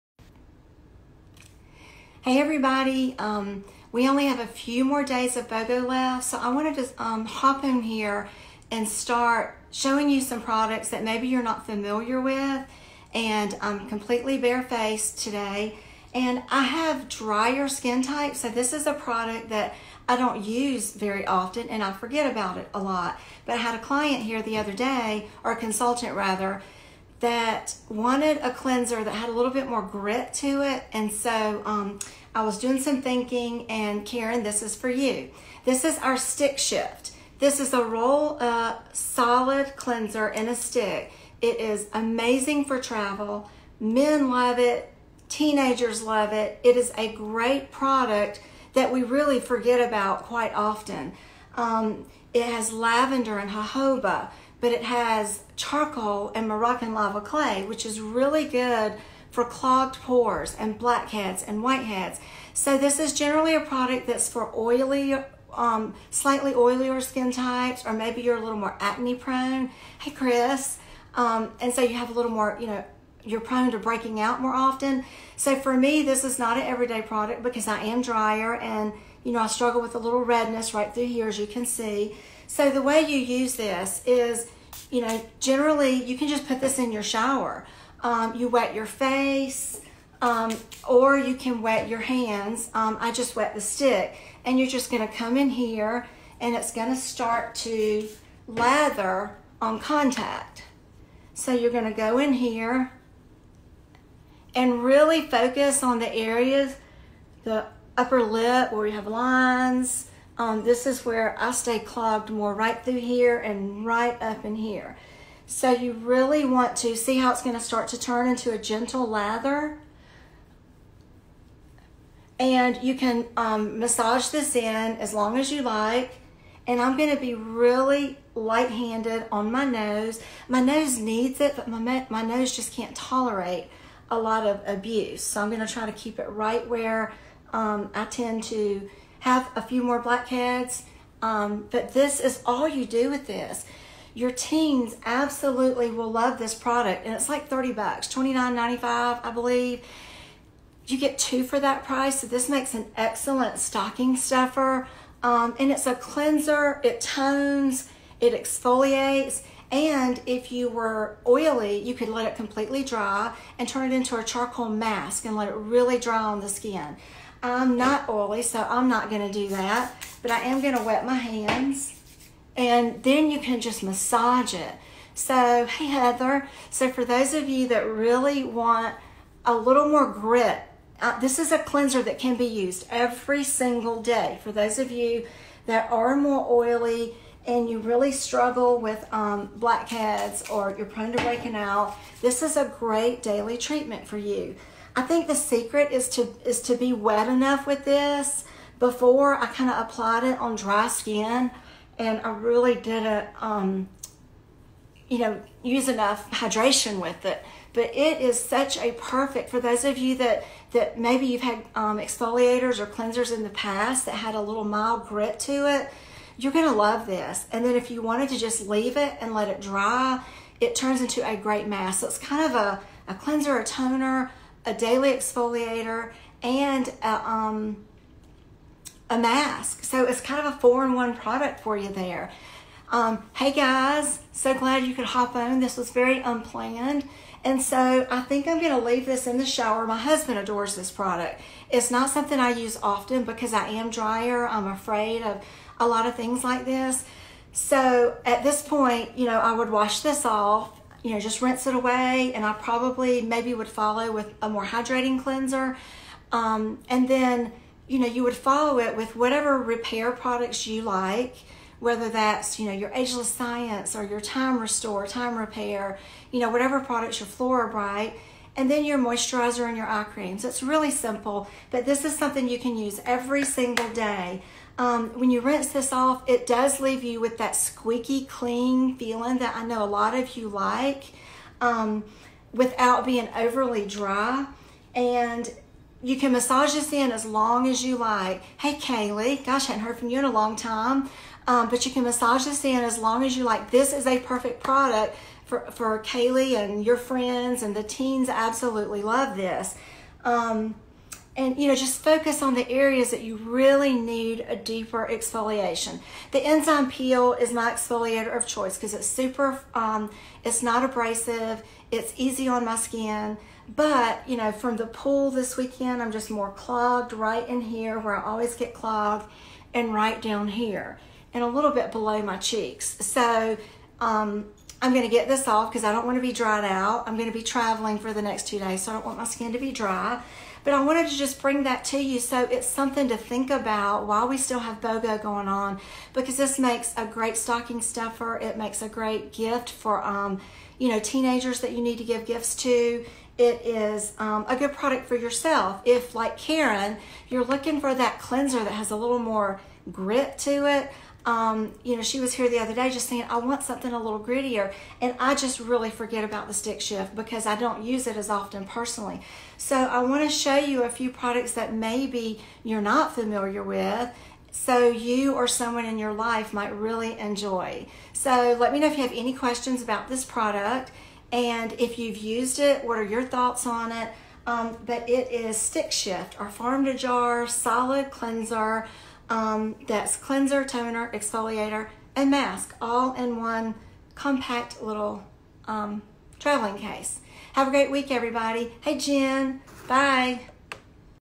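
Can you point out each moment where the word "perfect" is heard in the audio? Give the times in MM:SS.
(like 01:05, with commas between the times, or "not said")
03:28, 04:54.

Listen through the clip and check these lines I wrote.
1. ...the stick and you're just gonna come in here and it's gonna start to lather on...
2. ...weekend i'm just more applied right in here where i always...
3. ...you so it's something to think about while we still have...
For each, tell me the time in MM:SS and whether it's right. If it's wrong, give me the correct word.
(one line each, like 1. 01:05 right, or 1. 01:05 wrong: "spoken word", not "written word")
1. 01:33 right
2. 05:15 wrong: "clogged", not "applied"
3. 05:31 right.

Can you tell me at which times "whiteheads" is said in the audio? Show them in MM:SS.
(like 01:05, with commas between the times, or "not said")
01:01.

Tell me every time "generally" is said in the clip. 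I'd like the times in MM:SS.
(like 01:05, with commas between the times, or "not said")
01:03, 01:25.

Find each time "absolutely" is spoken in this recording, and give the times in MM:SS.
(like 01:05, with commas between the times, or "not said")
02:25, 04:58.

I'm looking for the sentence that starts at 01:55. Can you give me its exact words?
So you really want to see how it's going to start to turn into a gentle lather.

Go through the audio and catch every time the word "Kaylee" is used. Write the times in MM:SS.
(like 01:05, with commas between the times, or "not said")
04:48, 04:55.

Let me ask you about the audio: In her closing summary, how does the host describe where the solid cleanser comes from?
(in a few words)
farm to jar.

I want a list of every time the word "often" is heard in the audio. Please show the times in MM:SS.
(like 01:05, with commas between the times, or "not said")
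00:21, 00:50, 01:14, 04:02, 05:58.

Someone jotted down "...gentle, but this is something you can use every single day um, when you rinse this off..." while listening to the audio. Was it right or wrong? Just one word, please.
wrong.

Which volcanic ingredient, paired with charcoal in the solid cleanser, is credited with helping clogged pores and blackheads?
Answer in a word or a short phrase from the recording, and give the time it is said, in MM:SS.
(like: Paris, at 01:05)
Moroccan lava clay, at 00:56.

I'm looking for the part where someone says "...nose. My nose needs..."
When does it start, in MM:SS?
02:09.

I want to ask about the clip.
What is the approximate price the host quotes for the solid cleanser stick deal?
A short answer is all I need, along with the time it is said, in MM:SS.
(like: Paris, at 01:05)
$29.95, at 02:28.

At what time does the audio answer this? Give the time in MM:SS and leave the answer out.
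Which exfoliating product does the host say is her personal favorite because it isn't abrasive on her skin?
05:06.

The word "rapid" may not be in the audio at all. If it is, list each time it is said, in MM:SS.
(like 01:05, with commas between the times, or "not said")
not said.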